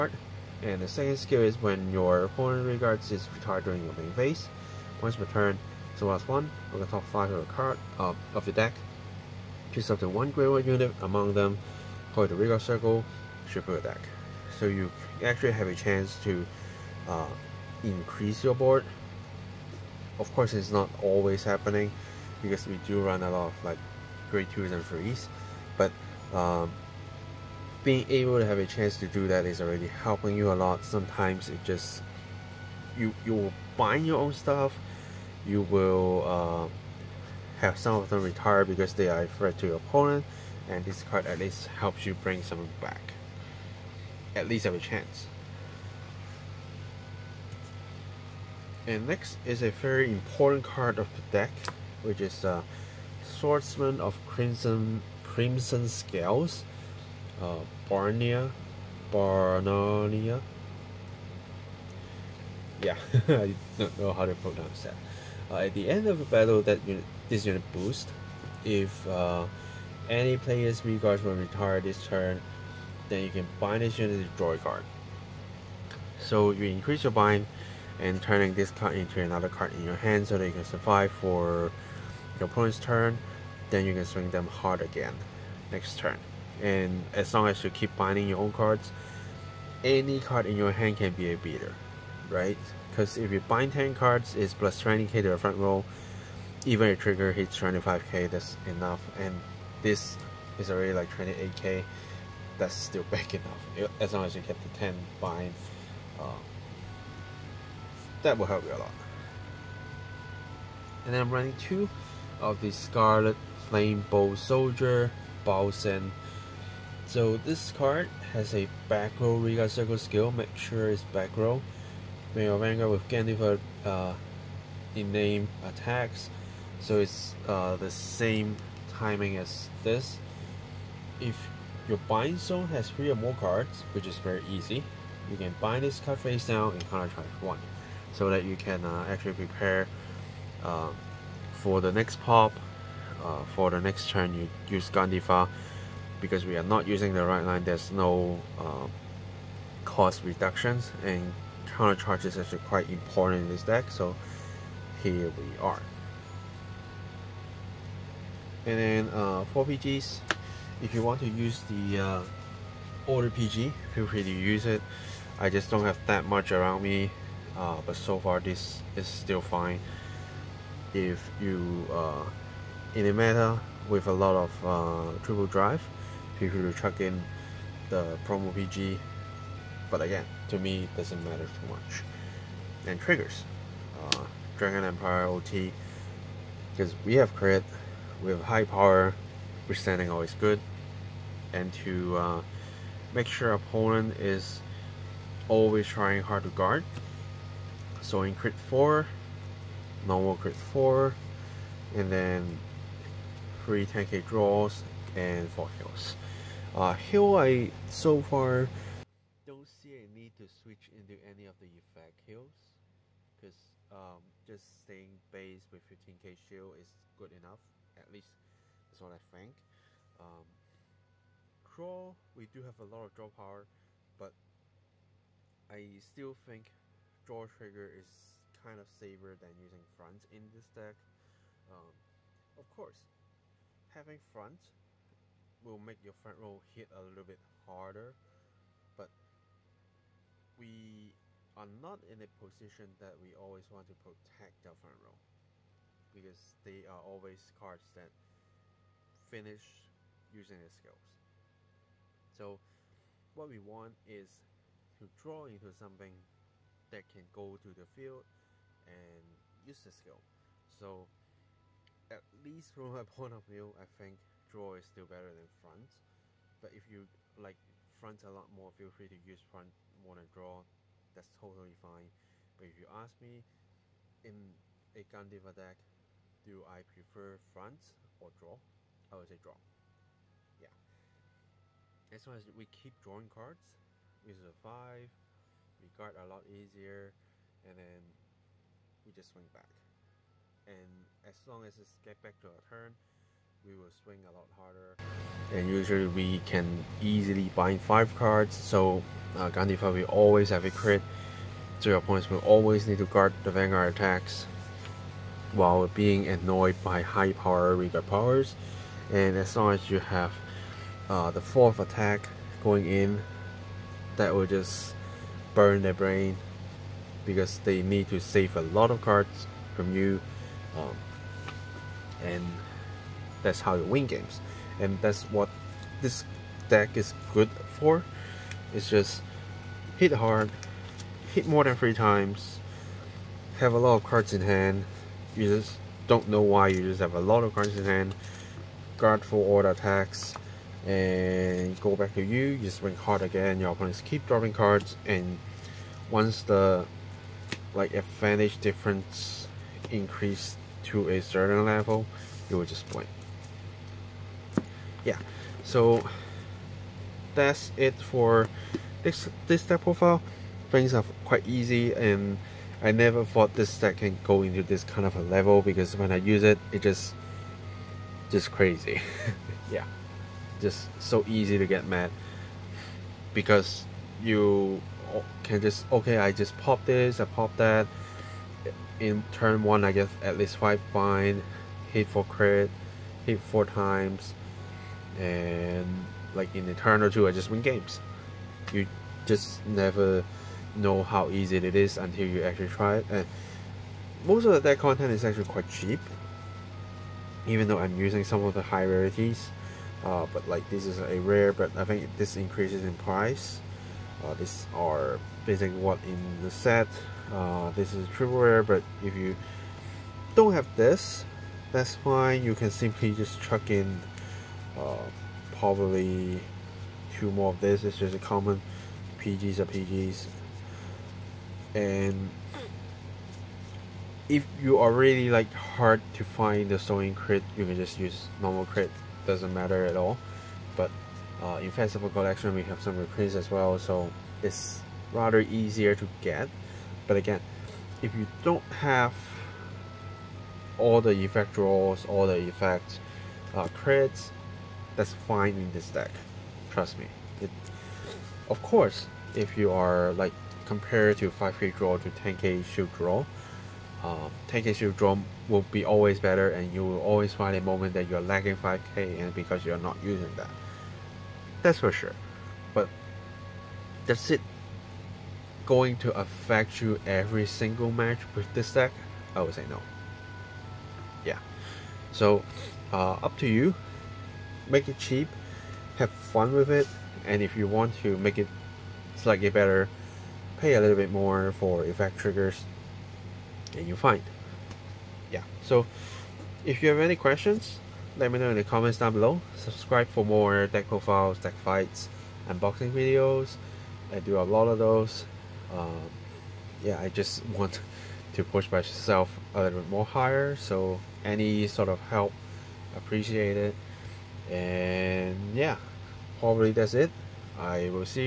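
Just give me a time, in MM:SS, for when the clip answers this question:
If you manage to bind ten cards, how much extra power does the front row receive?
01:34.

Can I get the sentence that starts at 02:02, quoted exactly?
When your Vanguard with Gandiva, uh, in name attacks, so it's uh, the same timing as this.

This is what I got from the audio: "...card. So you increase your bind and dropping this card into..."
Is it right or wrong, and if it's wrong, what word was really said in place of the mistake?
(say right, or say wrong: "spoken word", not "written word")
wrong: "turning", not "dropping".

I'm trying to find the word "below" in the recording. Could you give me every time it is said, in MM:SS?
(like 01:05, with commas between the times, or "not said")
08:09.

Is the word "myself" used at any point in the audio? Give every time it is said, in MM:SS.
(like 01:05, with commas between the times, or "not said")
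08:18.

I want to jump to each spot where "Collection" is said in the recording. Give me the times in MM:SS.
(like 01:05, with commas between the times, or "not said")
07:12.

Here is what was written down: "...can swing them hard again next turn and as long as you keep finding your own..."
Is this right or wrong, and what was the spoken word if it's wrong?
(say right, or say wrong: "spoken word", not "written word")
right.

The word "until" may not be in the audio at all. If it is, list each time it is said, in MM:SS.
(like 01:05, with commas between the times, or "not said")
06:31.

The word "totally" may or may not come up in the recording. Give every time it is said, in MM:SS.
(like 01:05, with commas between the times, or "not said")
04:31.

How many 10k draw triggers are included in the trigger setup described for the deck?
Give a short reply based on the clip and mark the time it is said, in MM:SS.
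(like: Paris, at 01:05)
3, at 03:23.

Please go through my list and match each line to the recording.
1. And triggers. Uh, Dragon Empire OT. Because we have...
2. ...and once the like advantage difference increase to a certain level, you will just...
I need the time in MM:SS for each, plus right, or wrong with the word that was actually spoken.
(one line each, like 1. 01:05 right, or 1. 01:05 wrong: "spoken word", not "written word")
1. 03:02 right
2. 05:45 right.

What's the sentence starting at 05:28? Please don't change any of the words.
It's just hit hard, hit more than three times, have a lot of cards in hand.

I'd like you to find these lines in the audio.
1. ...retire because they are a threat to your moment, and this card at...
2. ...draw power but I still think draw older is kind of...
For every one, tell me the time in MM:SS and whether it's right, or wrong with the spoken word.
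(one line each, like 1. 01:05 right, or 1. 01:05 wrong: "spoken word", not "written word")
1. 00:38 wrong: "opponent", not "moment"
2. 03:43 wrong: "trigger", not "older".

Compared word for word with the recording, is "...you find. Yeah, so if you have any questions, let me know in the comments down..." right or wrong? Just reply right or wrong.
right.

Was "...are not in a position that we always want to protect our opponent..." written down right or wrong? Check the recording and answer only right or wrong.
wrong.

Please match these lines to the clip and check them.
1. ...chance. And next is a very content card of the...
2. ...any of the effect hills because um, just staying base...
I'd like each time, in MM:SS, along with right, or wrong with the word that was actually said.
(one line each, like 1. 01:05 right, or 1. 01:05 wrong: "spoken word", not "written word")
1. 00:44 wrong: "important", not "content"
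2. 03:31 right.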